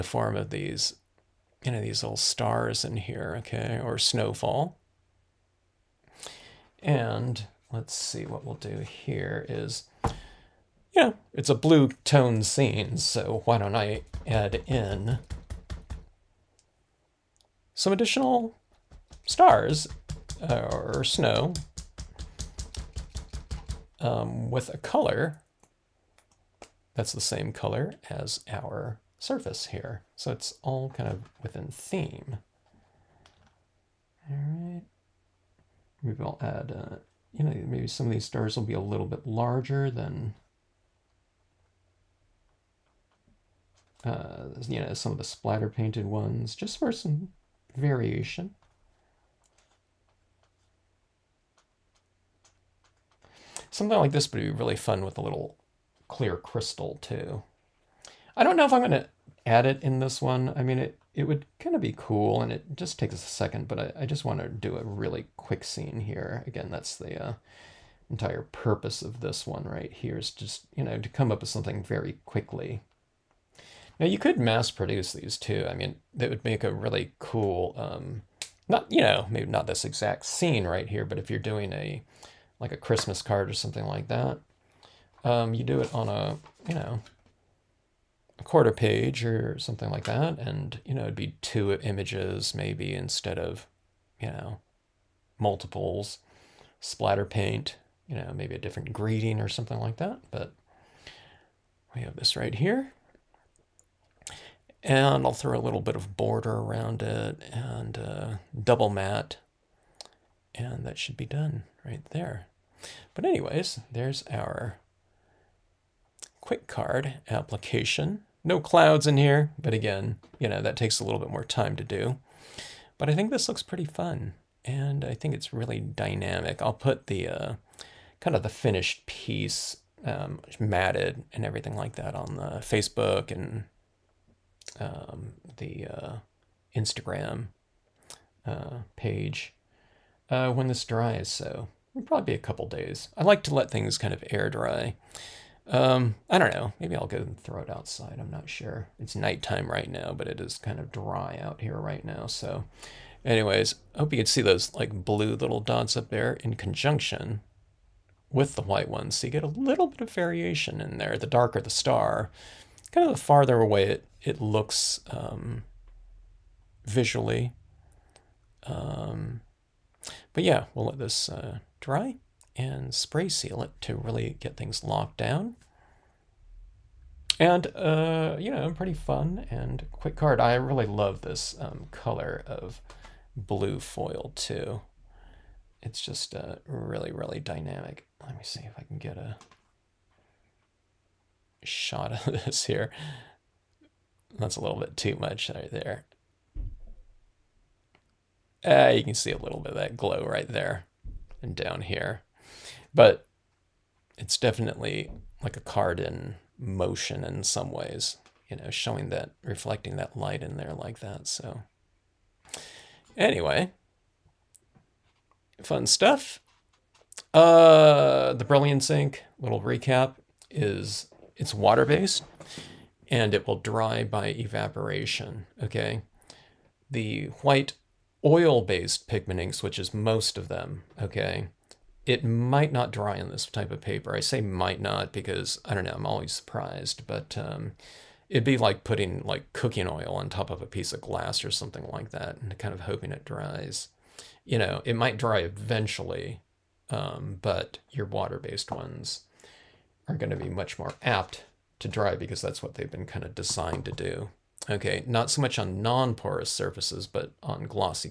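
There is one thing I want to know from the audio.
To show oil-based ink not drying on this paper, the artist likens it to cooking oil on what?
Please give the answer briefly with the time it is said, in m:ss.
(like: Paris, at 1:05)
glass, at 4:00.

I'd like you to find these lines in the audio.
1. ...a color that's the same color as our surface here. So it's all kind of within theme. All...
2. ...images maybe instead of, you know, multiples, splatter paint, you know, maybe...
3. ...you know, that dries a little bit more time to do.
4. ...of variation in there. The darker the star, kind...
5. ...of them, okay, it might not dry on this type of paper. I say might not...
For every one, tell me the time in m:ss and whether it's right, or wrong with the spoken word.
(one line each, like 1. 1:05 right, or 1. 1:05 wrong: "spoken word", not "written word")
1. 0:24 right
2. 1:31 right
3. 2:00 wrong: "takes", not "dries"
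4. 2:39 right
5. 3:50 right.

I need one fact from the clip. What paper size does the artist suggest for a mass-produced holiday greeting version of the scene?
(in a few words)
quarter page.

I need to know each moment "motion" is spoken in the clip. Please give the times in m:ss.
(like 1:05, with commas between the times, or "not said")
3:26.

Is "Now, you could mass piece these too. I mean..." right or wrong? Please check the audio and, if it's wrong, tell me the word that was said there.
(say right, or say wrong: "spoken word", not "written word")
wrong: "produce", not "piece".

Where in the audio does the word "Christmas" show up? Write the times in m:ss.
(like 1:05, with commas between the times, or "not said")
1:22.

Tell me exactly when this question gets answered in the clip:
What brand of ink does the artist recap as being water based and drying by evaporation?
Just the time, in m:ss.
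3:38.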